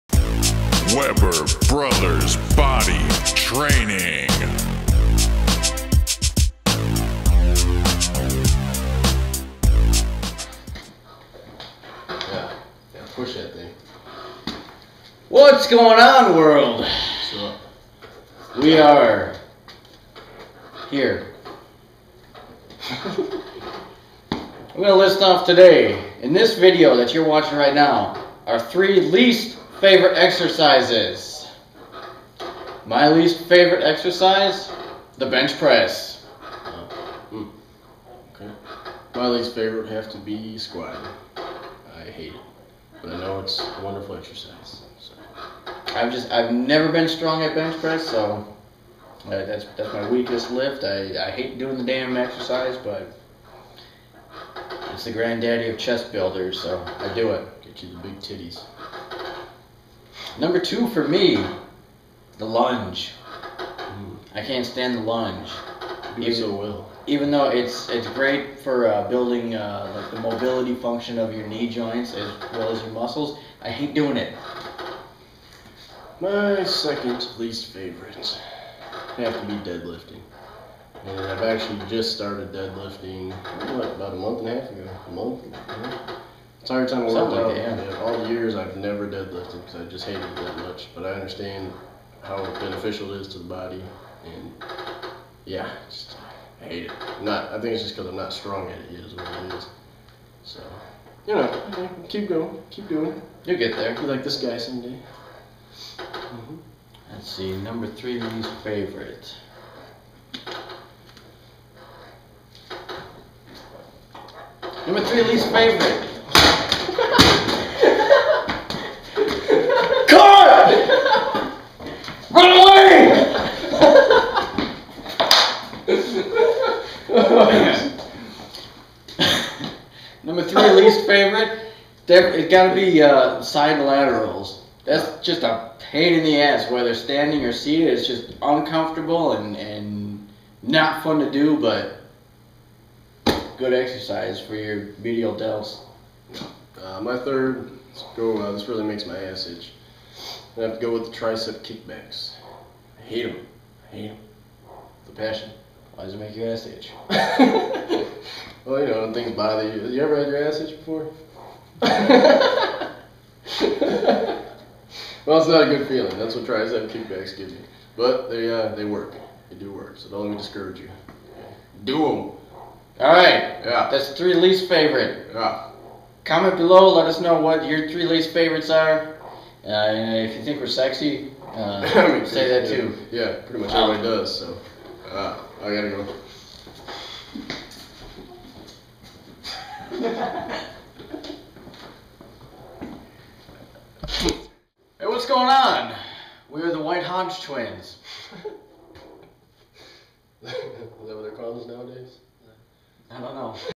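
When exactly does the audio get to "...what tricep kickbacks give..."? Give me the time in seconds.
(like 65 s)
166 s.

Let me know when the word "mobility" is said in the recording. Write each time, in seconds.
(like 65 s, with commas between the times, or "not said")
70 s.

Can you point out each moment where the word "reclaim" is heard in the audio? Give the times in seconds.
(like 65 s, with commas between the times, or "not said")
not said.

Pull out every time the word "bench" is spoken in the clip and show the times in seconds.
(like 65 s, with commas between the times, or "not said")
35 s, 47 s.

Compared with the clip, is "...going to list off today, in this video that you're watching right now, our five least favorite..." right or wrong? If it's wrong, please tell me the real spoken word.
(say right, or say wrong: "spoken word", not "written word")
wrong: "three", not "five".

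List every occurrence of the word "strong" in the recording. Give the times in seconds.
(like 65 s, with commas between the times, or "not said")
47 s, 98 s.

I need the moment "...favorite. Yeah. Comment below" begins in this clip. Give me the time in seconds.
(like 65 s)
174 s.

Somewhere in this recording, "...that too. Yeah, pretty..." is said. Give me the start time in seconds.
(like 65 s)
182 s.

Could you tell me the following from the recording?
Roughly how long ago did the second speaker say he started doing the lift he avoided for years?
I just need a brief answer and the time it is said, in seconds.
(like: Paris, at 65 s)
A month and a half, at 83 s.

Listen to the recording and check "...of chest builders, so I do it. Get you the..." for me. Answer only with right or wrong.
right.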